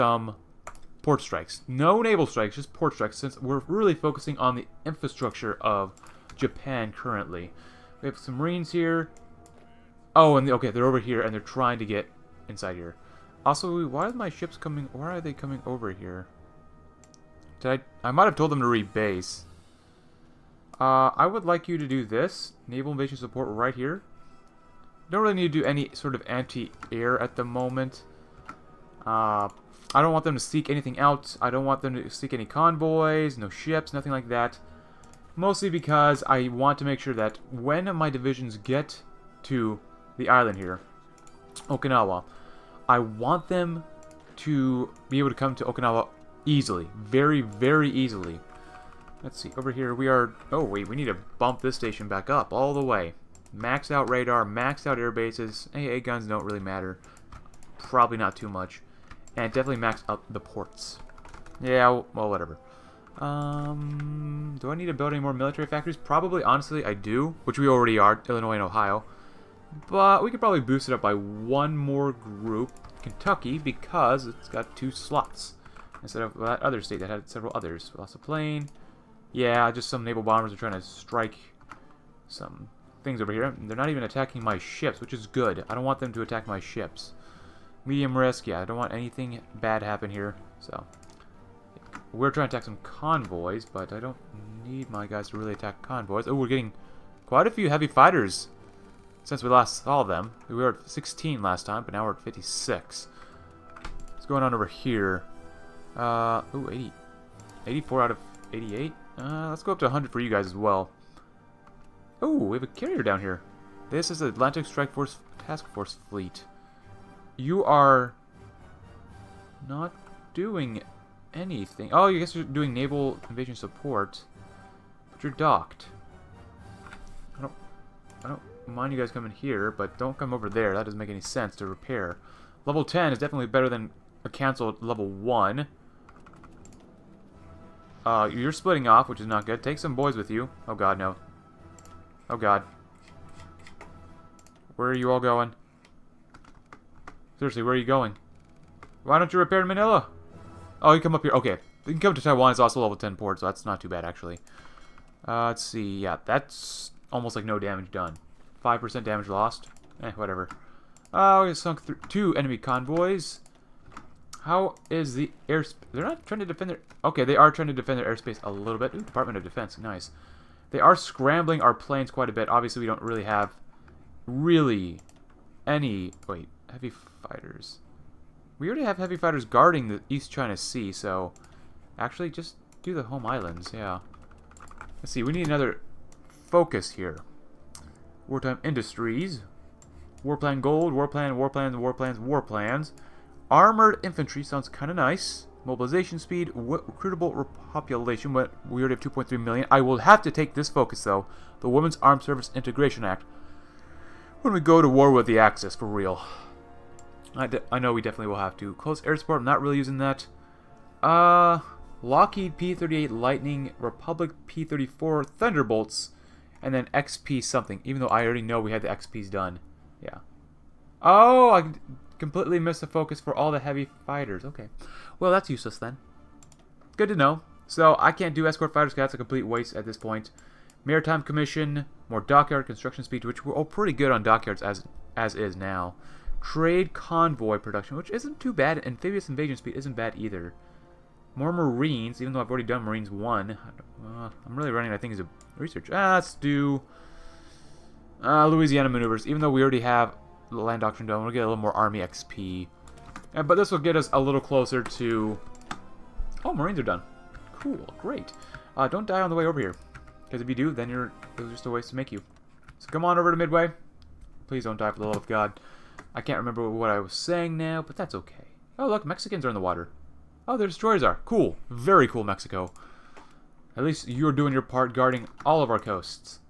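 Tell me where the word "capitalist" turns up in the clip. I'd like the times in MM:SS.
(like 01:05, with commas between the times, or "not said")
not said.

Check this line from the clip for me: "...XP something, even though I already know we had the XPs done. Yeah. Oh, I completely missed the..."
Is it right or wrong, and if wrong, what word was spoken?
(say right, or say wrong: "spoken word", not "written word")
right.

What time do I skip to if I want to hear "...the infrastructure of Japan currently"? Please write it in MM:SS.
00:04.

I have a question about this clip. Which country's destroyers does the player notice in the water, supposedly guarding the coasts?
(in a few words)
Mexico.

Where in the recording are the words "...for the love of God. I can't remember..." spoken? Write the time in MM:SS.
04:24.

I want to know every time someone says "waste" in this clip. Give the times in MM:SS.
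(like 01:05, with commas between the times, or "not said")
03:49, 04:21.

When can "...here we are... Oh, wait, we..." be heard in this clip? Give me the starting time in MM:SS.
00:49.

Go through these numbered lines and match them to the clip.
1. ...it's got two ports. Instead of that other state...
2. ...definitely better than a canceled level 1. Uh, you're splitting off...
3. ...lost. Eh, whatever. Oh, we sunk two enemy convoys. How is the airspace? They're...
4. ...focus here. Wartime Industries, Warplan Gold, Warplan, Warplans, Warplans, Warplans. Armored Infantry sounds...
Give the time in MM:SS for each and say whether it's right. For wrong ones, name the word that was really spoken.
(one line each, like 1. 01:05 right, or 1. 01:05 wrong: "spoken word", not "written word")
1. 01:14 wrong: "slots", not "ports"
2. 02:13 right
3. 02:39 right
4. 03:06 right.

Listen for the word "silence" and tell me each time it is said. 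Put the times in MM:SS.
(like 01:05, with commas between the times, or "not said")
not said.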